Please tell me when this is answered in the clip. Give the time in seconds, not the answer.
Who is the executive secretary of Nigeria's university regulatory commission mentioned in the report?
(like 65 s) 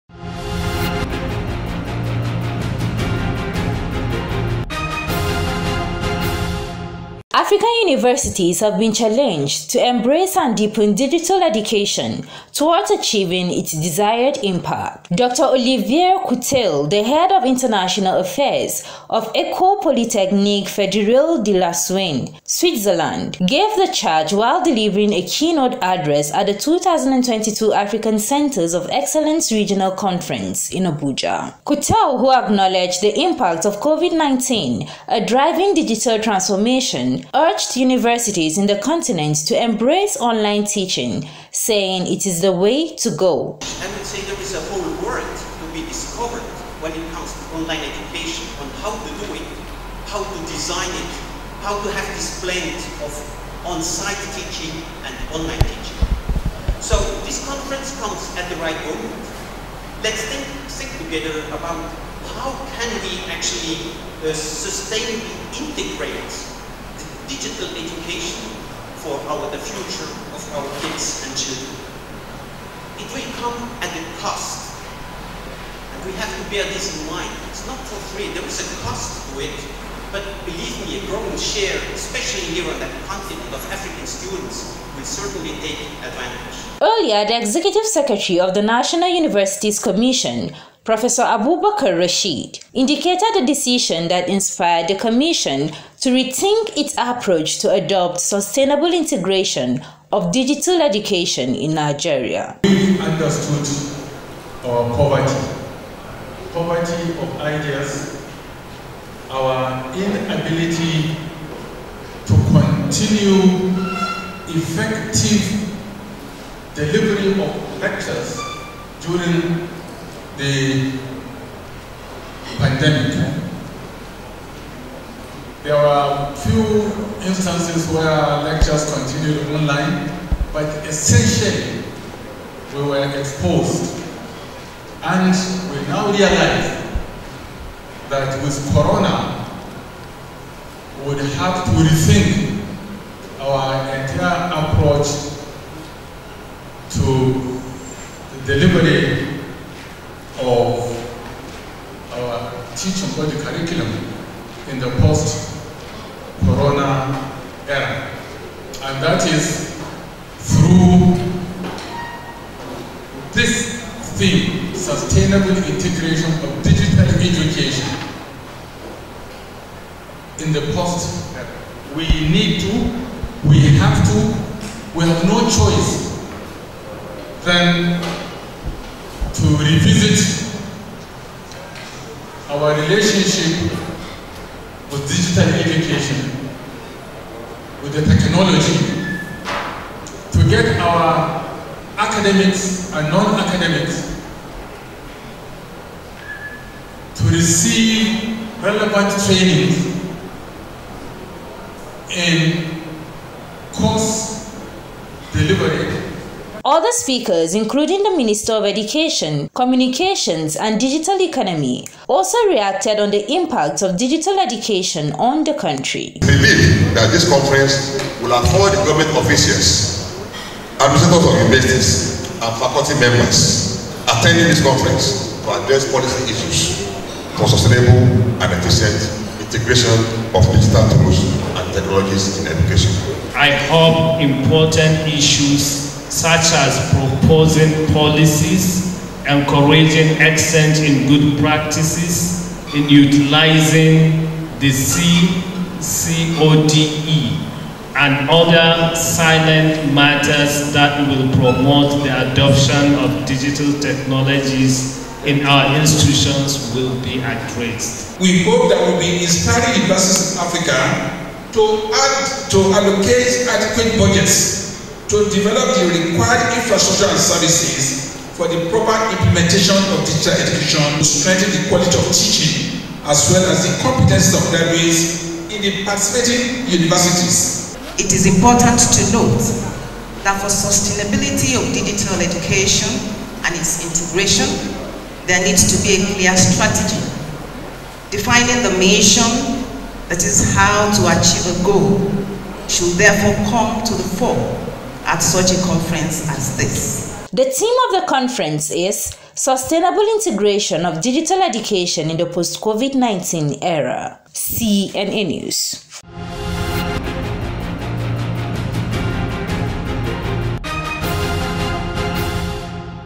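91 s.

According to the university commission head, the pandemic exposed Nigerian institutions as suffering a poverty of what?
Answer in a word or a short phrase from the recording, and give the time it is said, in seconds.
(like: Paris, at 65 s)
ideas, at 107 s.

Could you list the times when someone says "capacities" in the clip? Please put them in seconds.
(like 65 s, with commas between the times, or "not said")
not said.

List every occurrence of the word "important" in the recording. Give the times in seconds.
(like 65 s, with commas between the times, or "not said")
234 s, 278 s.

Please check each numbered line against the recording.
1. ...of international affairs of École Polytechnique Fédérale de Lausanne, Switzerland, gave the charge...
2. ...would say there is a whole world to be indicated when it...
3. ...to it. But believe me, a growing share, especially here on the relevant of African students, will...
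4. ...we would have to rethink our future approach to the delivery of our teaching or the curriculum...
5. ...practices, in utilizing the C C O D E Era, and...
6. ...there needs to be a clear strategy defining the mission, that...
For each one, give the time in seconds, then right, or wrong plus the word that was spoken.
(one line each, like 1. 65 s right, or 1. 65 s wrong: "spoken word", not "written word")
1. 17 s right
2. 43 s wrong: "discovered", not "indicated"
3. 79 s wrong: "continent", not "relevant"
4. 140 s wrong: "entire", not "future"
5. 241 s wrong: "CODE", not "Era"
6. 285 s right.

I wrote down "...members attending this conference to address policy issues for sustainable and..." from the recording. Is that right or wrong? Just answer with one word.
right.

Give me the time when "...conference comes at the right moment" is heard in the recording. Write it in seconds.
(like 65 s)
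57 s.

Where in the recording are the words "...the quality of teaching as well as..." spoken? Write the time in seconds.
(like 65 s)
271 s.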